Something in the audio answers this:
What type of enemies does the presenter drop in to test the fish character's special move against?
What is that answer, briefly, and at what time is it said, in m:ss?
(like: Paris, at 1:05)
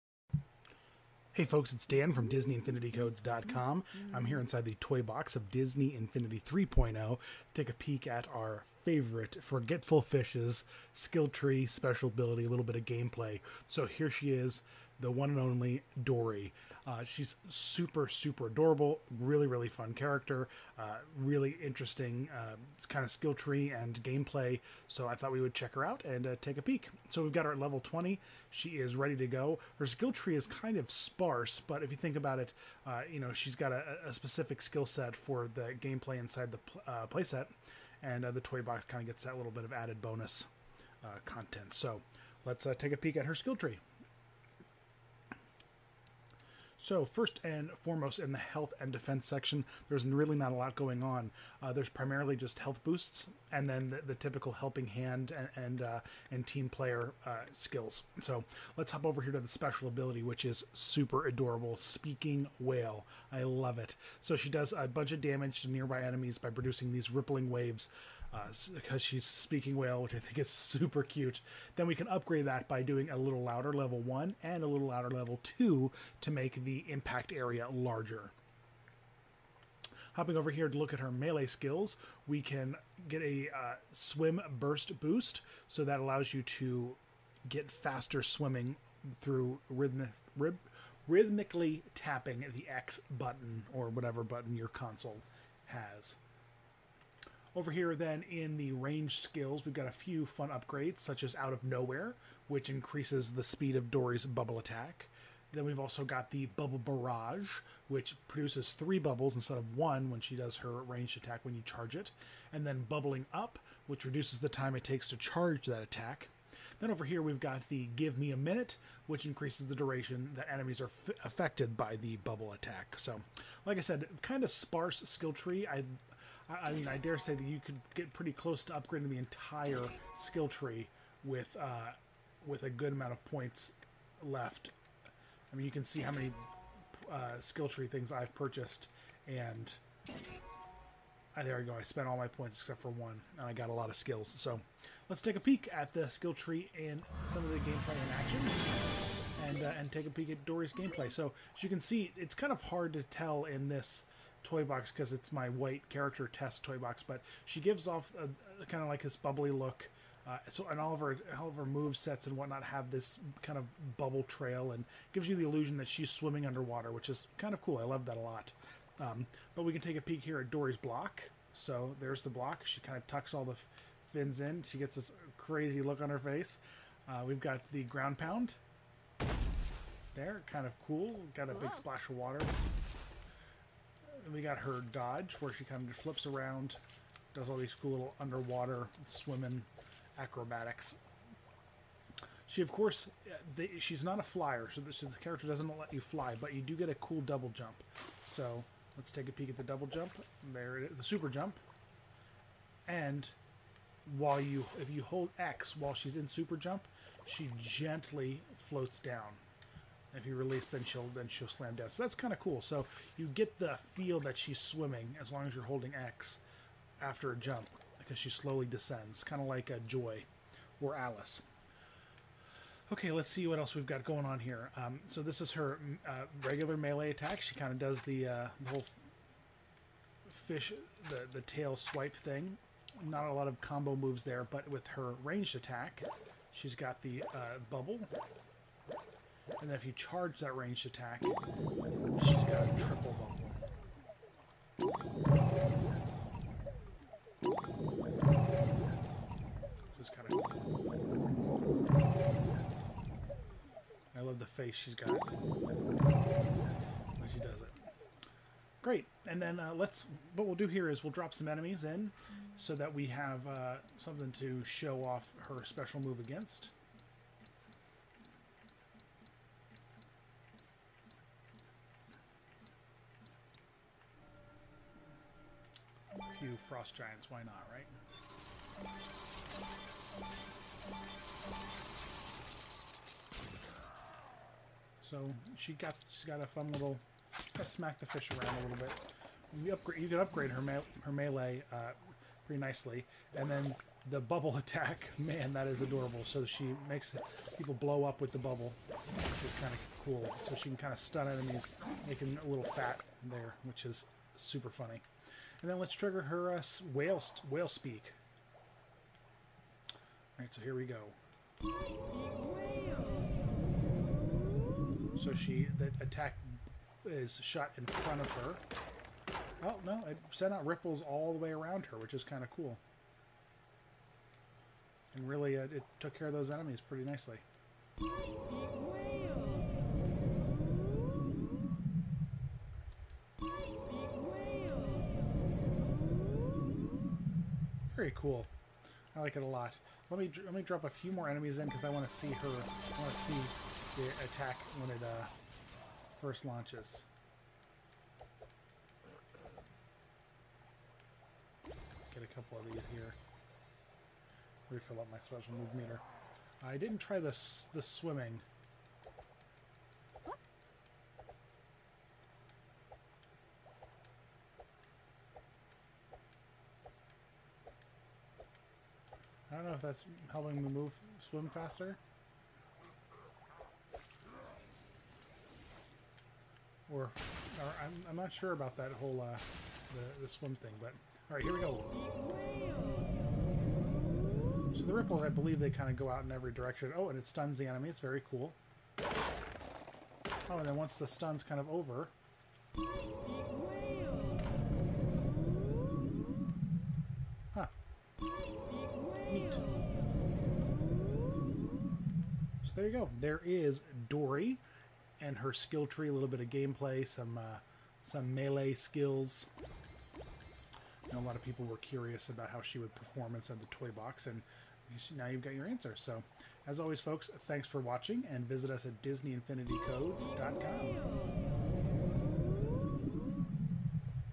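Frost giants, at 4:36.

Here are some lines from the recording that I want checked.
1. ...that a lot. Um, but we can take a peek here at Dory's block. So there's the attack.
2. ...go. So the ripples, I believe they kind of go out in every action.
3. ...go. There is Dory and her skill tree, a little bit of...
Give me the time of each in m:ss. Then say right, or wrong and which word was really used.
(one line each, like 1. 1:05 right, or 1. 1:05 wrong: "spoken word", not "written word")
1. 2:48 wrong: "block", not "attack"
2. 6:21 wrong: "direction", not "action"
3. 6:42 right.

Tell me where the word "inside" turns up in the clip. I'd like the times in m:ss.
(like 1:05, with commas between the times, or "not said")
0:04, 0:36, 6:53.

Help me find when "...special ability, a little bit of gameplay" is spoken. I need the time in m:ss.
0:11.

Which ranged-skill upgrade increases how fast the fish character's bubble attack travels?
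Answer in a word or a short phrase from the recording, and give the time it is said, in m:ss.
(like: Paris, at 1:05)
Out of Nowhere, at 1:41.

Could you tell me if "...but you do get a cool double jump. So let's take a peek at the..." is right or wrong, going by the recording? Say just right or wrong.
right.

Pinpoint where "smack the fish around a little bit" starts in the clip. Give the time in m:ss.
4:47.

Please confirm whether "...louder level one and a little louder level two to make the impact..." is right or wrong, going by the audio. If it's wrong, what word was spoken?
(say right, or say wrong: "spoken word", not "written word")
right.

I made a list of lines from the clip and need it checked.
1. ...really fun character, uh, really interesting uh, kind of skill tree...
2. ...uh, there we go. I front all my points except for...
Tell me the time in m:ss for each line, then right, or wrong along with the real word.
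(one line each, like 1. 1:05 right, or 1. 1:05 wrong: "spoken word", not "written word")
1. 0:19 right
2. 2:21 wrong: "spent", not "front".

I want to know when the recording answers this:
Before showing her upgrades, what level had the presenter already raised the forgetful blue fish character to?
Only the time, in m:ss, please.
0:27.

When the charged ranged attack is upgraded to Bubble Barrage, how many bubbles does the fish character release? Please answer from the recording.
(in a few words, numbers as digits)
3.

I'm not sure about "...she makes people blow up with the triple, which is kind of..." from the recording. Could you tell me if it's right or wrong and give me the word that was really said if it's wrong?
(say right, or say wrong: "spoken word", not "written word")
wrong: "bubble", not "triple".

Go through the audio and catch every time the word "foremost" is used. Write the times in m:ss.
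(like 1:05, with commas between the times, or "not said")
0:47.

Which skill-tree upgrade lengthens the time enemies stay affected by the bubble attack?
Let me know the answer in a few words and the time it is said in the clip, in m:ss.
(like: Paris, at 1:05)
Give Me a Minute, at 1:57.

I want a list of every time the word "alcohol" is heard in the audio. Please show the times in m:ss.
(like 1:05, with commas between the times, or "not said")
not said.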